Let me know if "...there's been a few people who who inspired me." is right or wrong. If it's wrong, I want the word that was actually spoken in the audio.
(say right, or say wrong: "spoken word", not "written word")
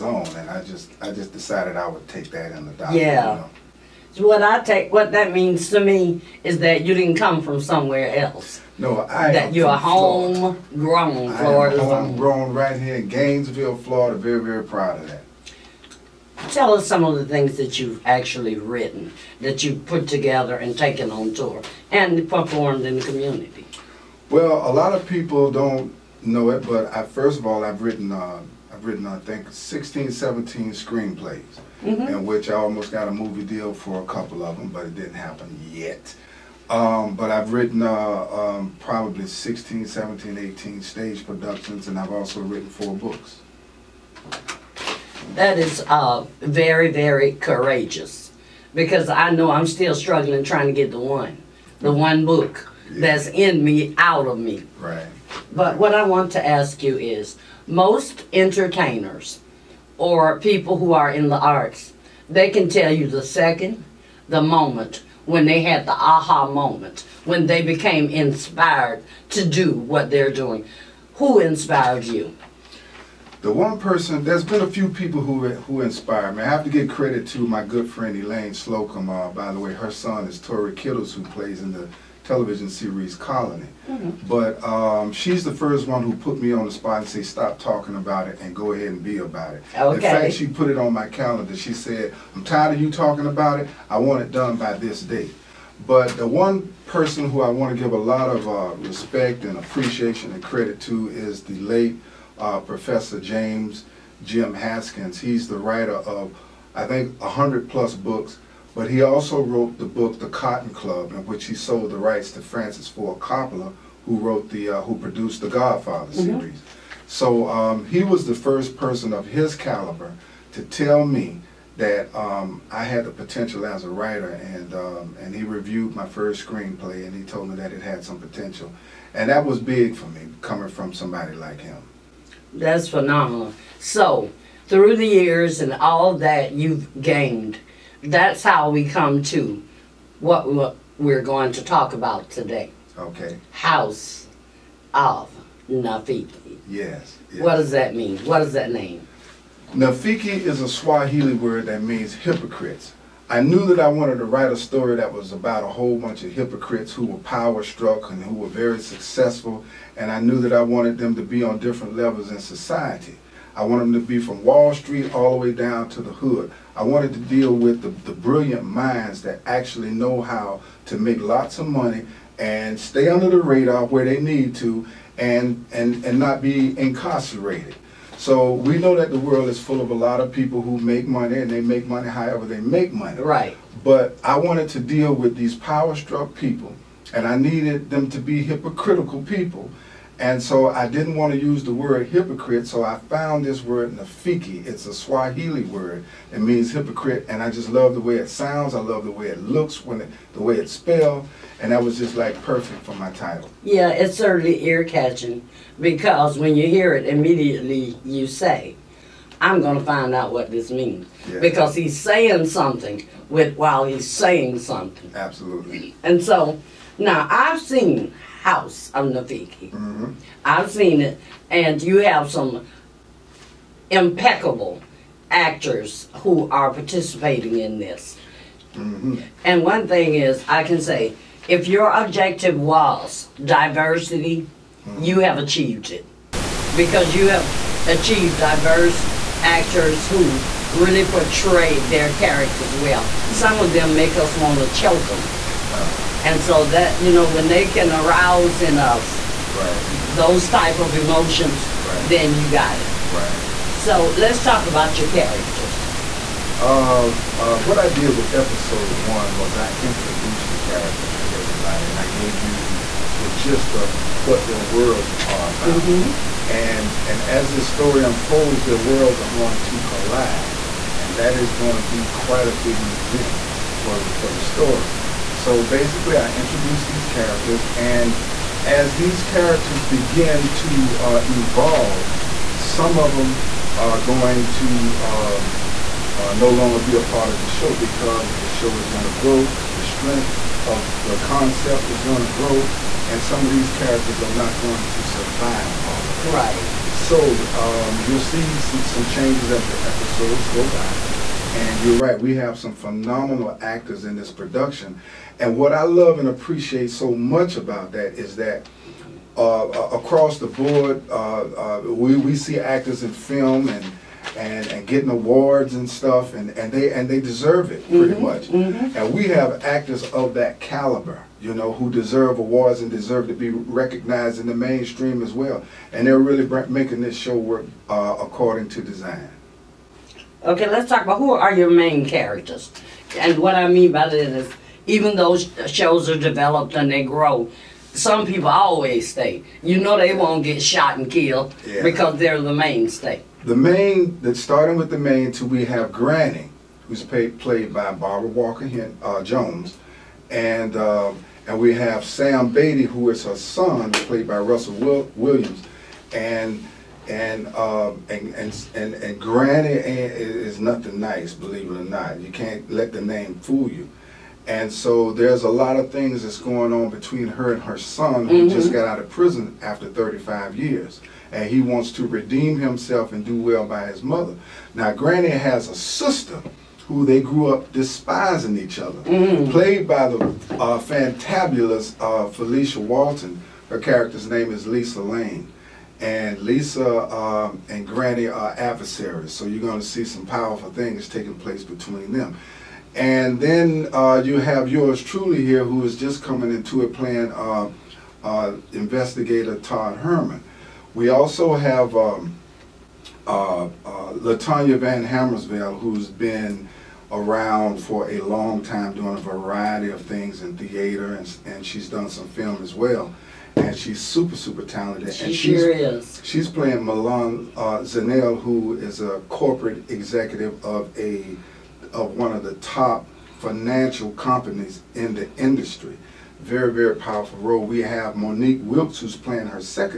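right.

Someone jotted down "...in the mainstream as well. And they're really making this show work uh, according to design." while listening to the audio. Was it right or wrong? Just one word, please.
right.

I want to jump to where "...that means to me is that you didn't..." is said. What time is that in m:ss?
0:05.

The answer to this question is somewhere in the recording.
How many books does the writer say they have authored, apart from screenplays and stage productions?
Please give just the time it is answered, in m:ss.
0:42.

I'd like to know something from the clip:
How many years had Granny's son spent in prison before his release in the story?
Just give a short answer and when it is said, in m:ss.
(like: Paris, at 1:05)
35, at 6:09.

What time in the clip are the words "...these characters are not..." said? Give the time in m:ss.
4:53.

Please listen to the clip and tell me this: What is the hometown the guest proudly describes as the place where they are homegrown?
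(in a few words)
Gainesville, Florida.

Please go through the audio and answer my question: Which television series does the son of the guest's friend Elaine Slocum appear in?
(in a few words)
Colony.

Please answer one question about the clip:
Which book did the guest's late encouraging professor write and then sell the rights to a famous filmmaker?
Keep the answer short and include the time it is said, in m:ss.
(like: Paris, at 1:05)
The Cotton Club, at 1:50.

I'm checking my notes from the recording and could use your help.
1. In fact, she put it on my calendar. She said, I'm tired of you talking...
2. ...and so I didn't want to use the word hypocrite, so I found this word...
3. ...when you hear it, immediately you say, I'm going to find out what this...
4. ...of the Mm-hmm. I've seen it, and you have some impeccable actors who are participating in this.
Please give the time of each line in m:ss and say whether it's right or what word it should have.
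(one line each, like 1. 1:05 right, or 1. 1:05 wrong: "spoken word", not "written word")
1. 1:29 right
2. 3:10 right
3. 3:26 right
4. 3:38 right.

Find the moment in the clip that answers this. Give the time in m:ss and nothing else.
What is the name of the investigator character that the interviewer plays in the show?
6:39.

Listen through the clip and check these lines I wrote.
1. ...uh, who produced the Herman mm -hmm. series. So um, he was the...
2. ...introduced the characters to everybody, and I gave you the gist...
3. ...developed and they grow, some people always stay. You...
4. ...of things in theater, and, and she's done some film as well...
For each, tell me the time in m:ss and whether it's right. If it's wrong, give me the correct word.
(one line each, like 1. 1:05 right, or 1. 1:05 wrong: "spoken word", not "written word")
1. 1:54 wrong: "Godfather", not "Herman"
2. 4:19 right
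3. 5:36 right
4. 6:49 right.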